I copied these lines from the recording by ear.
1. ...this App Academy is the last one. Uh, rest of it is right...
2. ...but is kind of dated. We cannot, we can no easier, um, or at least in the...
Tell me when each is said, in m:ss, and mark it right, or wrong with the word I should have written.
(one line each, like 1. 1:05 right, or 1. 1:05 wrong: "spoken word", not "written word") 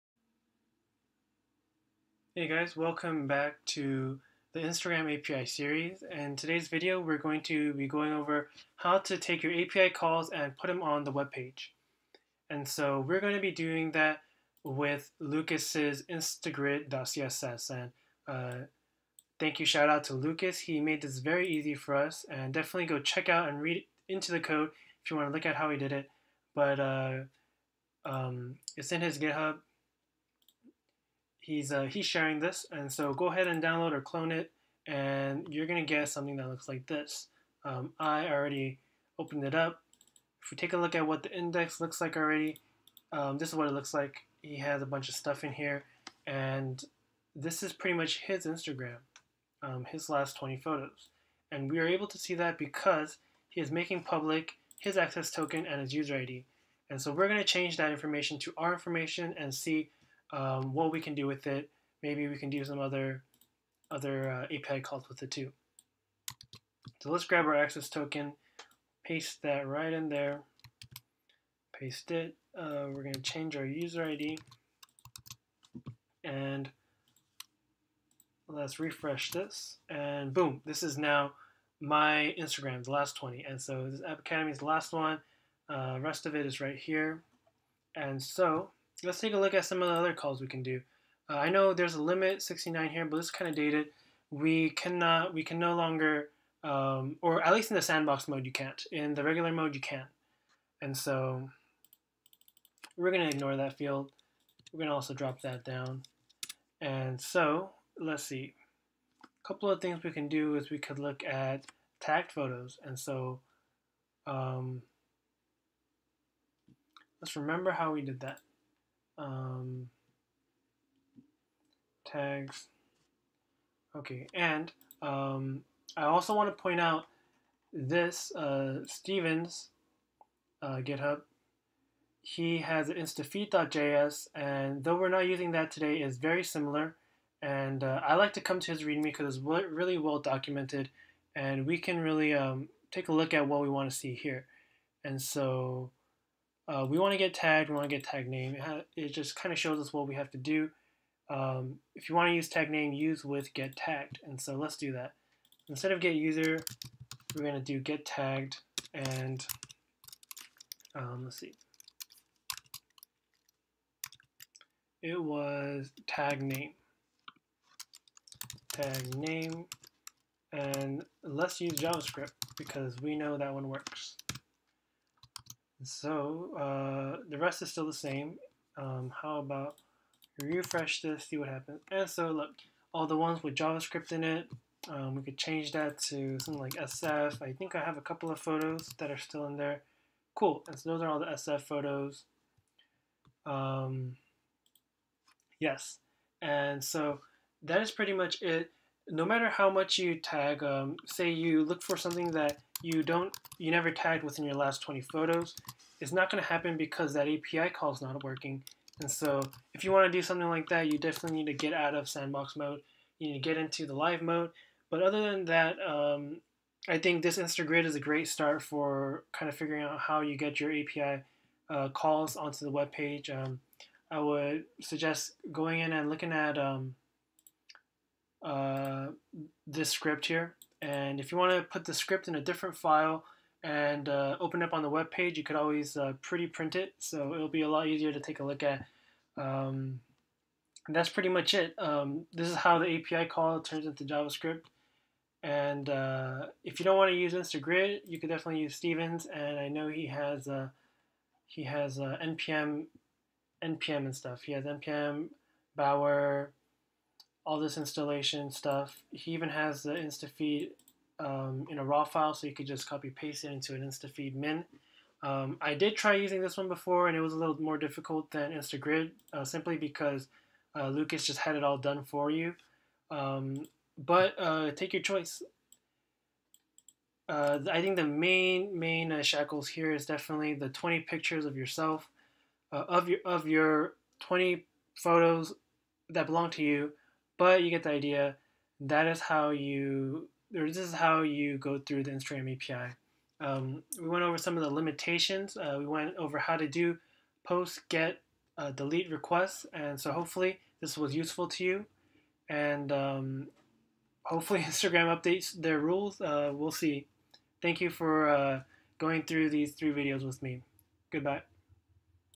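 1. 1:23 right
2. 1:33 wrong: "longer", not "easier".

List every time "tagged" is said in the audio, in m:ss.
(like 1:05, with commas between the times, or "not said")
1:51, 2:27, 2:33, 2:38, 3:23.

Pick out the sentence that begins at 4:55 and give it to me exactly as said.
Uh, we went over how to do post, get, uh, delete requests.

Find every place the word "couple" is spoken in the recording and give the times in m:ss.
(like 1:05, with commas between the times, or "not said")
1:49, 3:08.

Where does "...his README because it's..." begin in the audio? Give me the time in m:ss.
2:18.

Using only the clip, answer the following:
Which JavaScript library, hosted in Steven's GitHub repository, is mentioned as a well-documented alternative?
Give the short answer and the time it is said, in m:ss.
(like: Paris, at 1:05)
instafeed.js, at 2:12.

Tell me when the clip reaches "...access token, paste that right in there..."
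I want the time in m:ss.
1:07.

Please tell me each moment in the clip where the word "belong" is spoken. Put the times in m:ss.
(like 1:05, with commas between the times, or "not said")
4:46.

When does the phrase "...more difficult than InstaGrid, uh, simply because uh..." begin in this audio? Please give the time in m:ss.
4:27.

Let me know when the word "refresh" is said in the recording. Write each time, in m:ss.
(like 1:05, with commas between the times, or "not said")
1:18, 3:00.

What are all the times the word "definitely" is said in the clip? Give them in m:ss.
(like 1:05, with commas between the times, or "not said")
0:22, 3:30, 4:08, 4:40.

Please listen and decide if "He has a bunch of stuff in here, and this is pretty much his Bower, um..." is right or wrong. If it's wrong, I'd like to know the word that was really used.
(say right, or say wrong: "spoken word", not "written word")
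wrong: "Instagram", not "Bower".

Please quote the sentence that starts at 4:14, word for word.
He has npm Bower all this installation stuff.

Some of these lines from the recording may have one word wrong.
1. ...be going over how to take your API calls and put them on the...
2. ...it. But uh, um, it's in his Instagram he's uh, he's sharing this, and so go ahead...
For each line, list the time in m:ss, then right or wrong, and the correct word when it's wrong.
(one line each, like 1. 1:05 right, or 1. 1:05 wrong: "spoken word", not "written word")
1. 0:07 right
2. 0:25 wrong: "GitHub", not "Instagram".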